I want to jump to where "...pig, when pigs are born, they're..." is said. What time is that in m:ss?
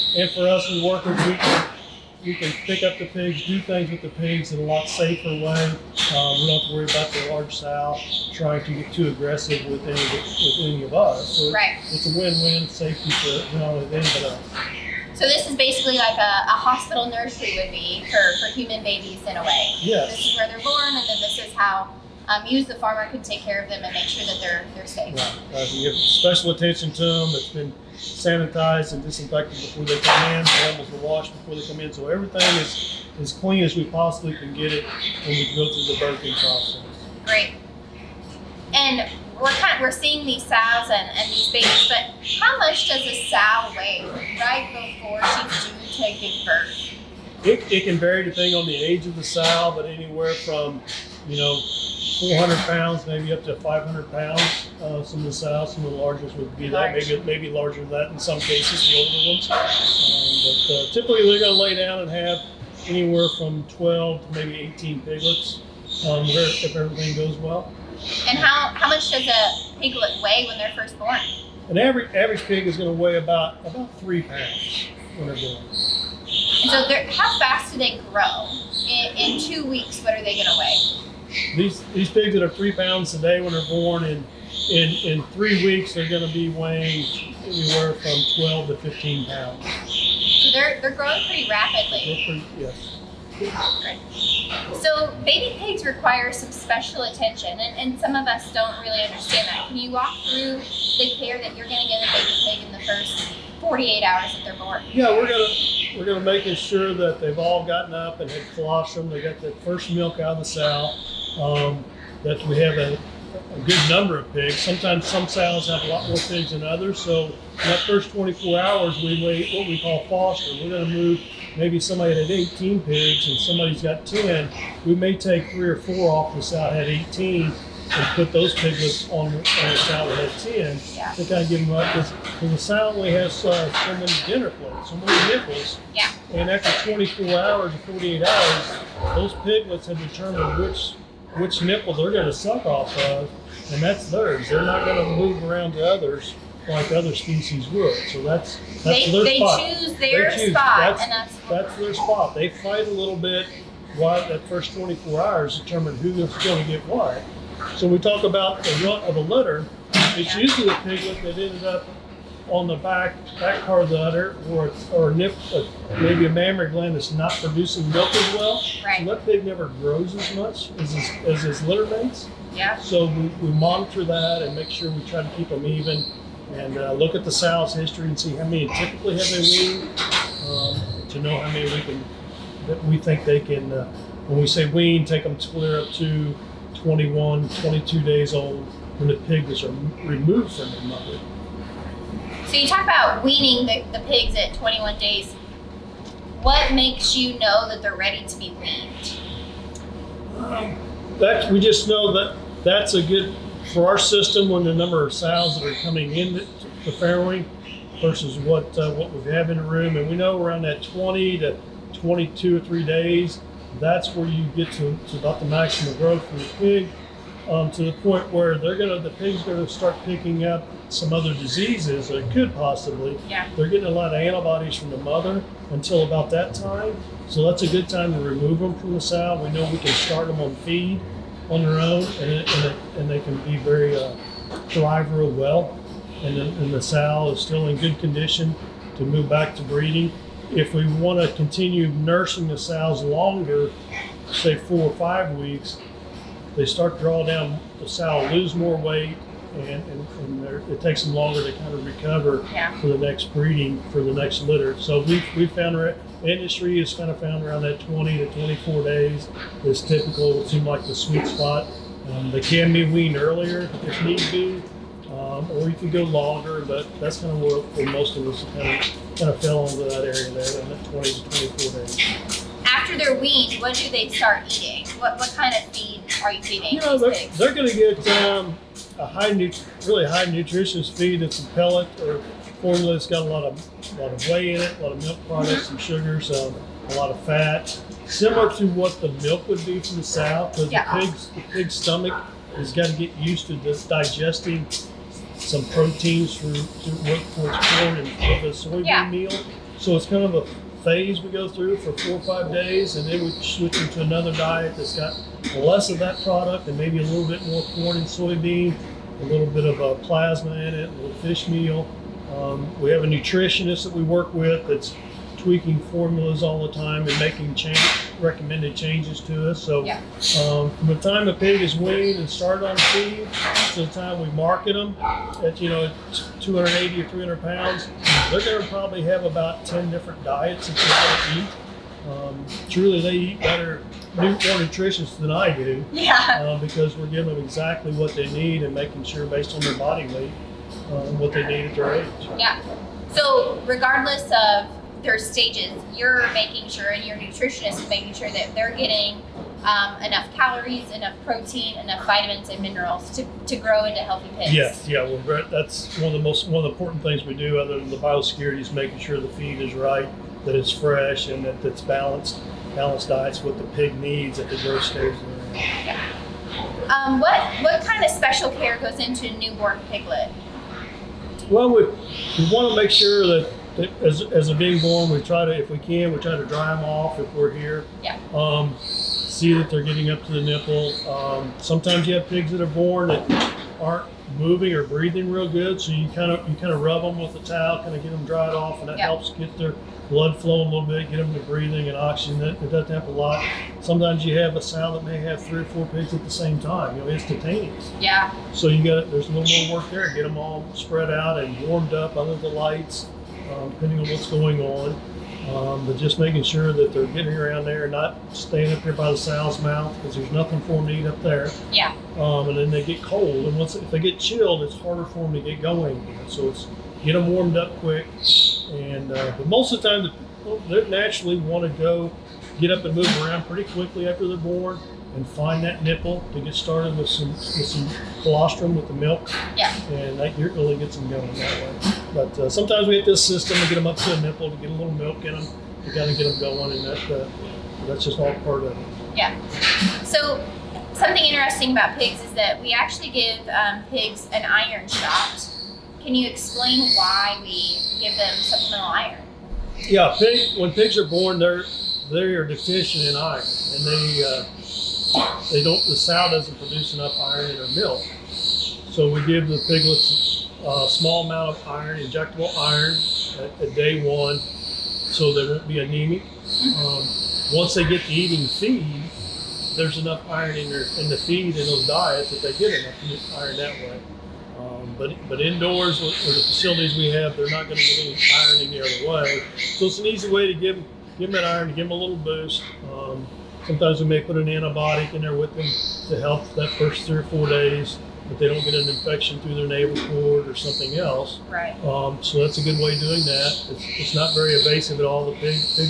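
7:30.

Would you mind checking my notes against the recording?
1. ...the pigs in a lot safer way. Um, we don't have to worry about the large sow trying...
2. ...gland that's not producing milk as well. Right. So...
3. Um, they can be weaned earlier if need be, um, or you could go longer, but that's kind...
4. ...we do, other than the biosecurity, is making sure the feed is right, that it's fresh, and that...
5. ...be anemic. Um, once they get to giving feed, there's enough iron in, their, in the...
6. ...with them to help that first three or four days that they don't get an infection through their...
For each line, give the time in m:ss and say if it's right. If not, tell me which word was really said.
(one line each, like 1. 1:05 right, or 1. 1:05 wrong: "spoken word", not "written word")
1. 0:04 right
2. 2:46 right
3. 4:22 right
4. 5:57 right
5. 7:45 wrong: "eating", not "giving"
6. 8:05 right.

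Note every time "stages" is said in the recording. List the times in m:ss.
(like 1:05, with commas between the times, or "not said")
5:45, 6:04.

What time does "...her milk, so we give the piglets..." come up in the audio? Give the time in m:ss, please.
7:37.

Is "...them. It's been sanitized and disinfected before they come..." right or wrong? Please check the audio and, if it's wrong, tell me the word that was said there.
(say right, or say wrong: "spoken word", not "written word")
right.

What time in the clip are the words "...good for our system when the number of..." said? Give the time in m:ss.
3:23.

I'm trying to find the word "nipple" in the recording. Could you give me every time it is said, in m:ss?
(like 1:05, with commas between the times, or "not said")
2:15, 2:21, 6:20, 7:05, 7:14.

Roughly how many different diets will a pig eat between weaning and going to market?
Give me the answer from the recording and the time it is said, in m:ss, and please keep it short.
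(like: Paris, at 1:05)
10, at 5:29.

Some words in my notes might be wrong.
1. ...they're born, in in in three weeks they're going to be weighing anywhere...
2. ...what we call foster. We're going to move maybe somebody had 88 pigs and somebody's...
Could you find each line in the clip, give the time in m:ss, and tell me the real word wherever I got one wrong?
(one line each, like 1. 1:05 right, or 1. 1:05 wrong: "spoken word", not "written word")
1. 1:23 right
2. 1:59 wrong: "18", not "88".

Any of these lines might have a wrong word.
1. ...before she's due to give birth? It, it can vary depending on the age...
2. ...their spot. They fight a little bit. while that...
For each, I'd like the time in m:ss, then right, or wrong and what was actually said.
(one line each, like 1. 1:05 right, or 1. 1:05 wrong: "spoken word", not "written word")
1. 0:44 right
2. 2:31 right.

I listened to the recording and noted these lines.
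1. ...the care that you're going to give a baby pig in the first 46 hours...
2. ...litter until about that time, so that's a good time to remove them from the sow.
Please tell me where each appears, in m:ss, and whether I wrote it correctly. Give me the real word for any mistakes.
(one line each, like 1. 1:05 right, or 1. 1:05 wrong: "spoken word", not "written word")
1. 1:40 wrong: "48", not "46"
2. 3:44 wrong: "mother", not "litter".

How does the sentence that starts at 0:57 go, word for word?
that, maybe maybe larger than that in some cases, the older ones.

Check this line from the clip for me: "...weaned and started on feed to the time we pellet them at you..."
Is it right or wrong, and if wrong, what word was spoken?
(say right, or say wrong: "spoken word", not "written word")
wrong: "market", not "pellet".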